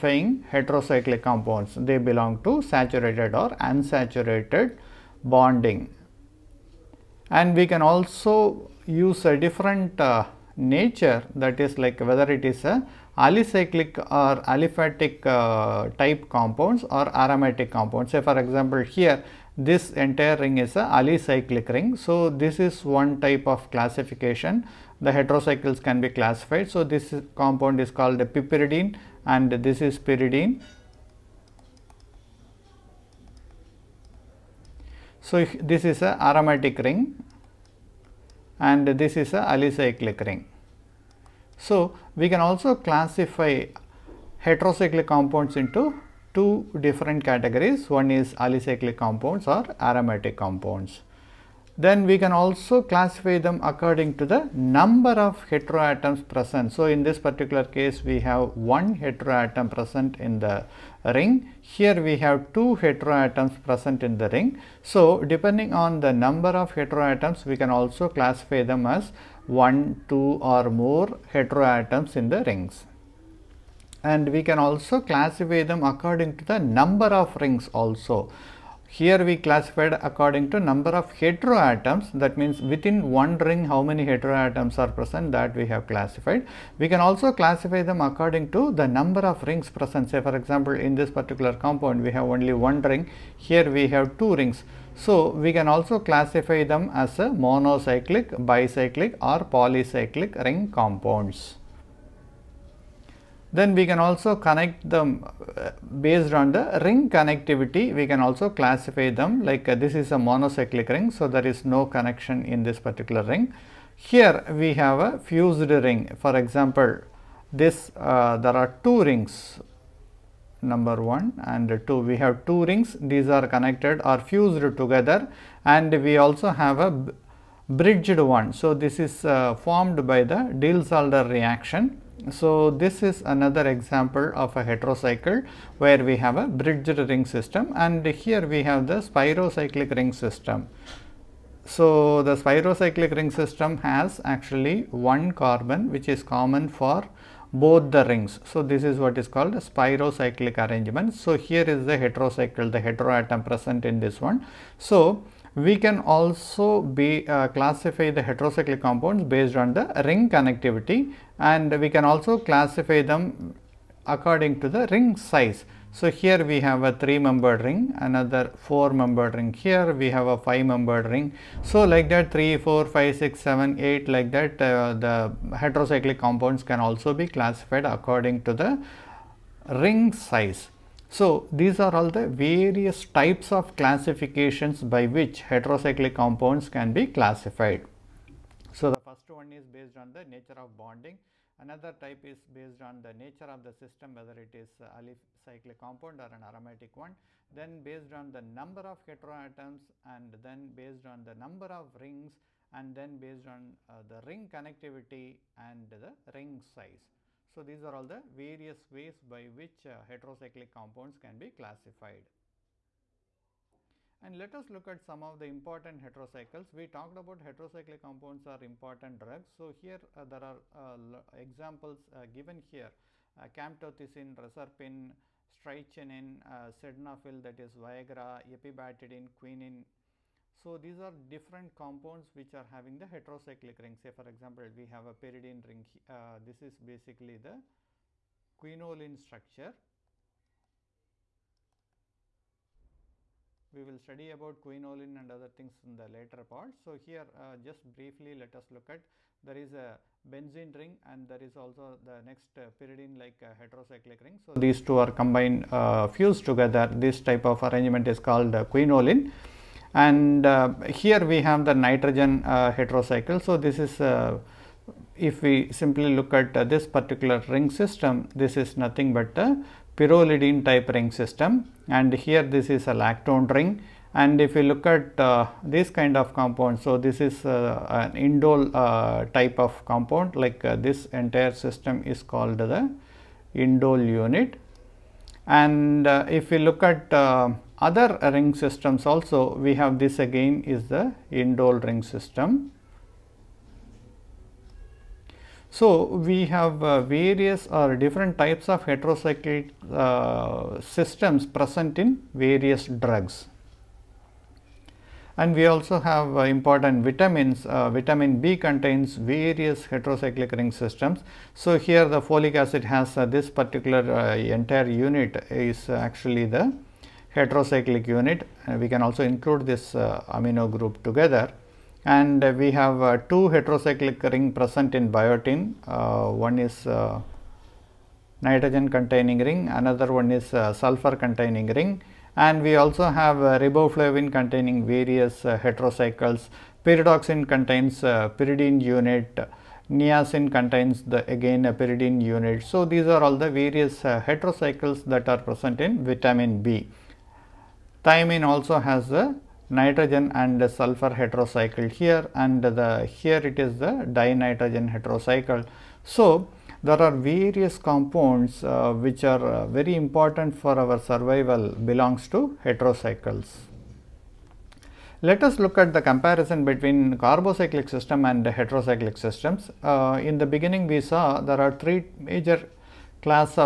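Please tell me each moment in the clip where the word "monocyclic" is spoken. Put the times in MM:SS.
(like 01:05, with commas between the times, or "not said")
01:37, 01:50.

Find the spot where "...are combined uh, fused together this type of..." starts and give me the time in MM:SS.
04:14.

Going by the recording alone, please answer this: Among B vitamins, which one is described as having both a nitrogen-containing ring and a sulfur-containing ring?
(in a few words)
Biotin.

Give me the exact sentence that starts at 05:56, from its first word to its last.
So, there are various compounds uh, which are uh, very important for our survival belongs to heterocycles.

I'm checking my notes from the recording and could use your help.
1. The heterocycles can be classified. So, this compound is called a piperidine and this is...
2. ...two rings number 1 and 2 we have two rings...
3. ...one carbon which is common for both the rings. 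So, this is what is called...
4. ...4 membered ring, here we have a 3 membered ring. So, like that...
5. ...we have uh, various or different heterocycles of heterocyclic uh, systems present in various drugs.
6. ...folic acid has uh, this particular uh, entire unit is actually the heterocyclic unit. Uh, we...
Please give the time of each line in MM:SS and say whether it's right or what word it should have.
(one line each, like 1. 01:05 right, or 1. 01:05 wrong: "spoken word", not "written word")
1. 00:25 right
2. 01:58 right
3. 02:24 right
4. 02:48 wrong: "5", not "3"
5. 04:56 wrong: "types", not "heterocycles"
6. 05:12 right.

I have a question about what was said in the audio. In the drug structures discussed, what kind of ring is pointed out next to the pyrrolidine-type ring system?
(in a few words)
Lactone ring.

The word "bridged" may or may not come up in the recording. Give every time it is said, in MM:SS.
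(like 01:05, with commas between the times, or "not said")
02:07, 02:16.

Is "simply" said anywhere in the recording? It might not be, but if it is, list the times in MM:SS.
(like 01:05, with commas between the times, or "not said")
04:25.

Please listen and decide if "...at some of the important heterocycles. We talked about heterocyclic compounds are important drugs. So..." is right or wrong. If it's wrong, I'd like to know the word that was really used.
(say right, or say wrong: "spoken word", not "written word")
right.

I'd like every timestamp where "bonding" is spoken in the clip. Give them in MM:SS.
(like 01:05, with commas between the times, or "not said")
00:05, 03:10.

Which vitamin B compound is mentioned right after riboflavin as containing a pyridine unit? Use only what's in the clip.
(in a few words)
Pyridoxine.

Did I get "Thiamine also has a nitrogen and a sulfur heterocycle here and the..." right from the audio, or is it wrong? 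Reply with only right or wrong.
right.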